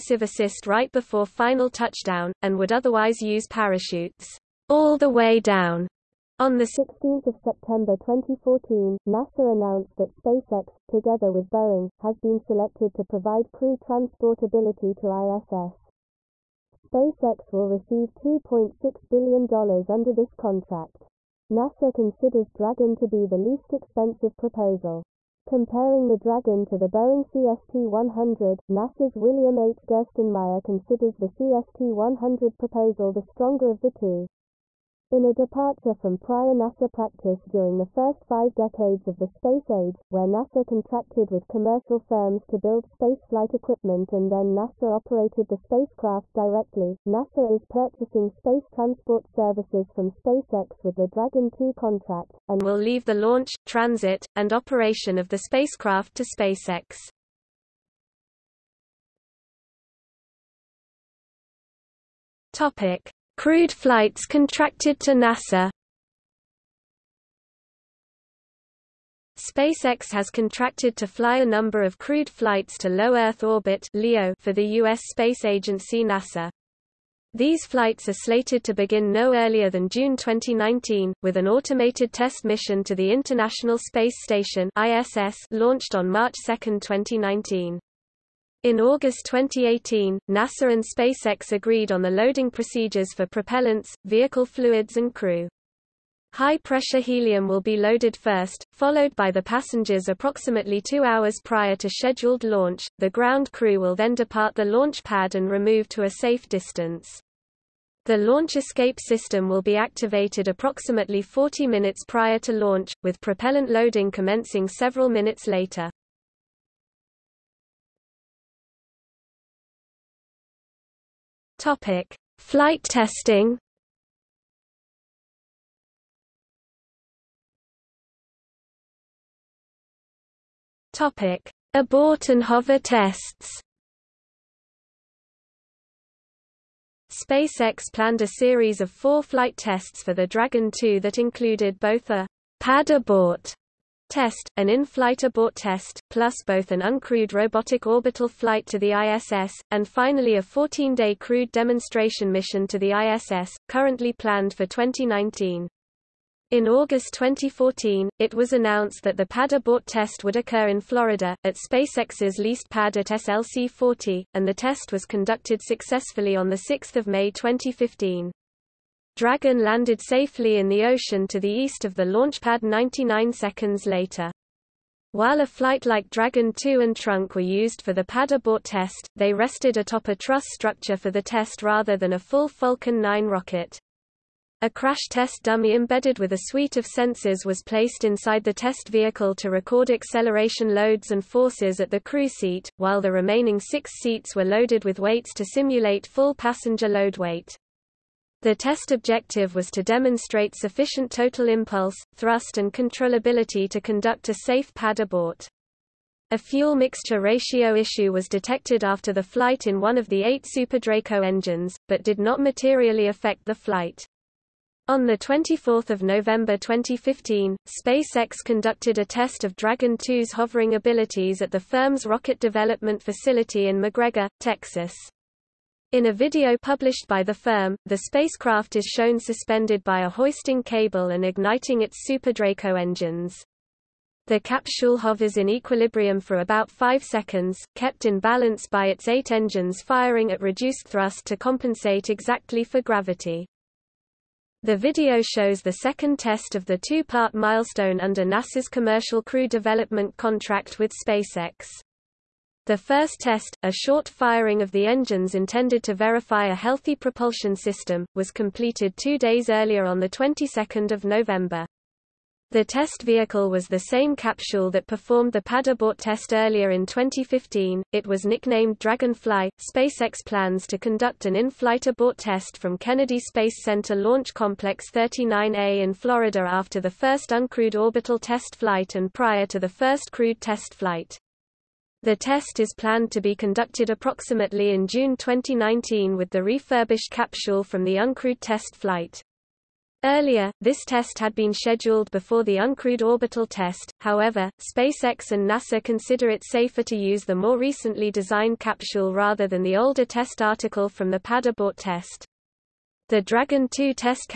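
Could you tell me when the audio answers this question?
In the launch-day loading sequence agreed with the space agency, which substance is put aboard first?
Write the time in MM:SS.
01:36.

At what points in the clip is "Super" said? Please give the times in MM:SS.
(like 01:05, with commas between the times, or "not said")
03:30, 03:52.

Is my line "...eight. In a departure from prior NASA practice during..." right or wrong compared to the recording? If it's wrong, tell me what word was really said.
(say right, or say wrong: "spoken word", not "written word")
wrong: "two", not "eight".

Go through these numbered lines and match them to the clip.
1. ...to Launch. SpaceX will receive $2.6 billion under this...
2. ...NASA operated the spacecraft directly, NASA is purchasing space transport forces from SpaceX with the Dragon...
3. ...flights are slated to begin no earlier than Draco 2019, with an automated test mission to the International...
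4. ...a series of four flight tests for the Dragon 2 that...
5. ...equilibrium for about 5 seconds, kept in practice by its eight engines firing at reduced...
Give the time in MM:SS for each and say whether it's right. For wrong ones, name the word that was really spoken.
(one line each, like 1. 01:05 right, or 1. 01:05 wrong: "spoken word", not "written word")
1. 00:14 wrong: "ISS", not "Launch"
2. 00:44 wrong: "services", not "forces"
3. 01:17 wrong: "June", not "Draco"
4. 02:18 right
5. 03:55 wrong: "balance", not "practice".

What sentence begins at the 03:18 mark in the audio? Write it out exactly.
The test objective was to demonstrate sufficient total impulse, thrust and controllability to conduct a safe pad abort.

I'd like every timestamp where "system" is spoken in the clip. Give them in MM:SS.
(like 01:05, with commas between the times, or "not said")
01:48, 04:17.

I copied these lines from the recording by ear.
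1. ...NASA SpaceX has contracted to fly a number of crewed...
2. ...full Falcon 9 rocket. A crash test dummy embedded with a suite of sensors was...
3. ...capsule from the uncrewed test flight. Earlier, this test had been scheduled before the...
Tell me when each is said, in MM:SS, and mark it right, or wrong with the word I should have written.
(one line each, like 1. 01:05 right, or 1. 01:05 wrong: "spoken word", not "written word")
1. 01:05 right
2. 03:02 right
3. 04:47 right.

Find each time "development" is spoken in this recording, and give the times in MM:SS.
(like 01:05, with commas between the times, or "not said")
03:42, 04:09.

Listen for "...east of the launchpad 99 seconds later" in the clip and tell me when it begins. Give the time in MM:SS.
02:51.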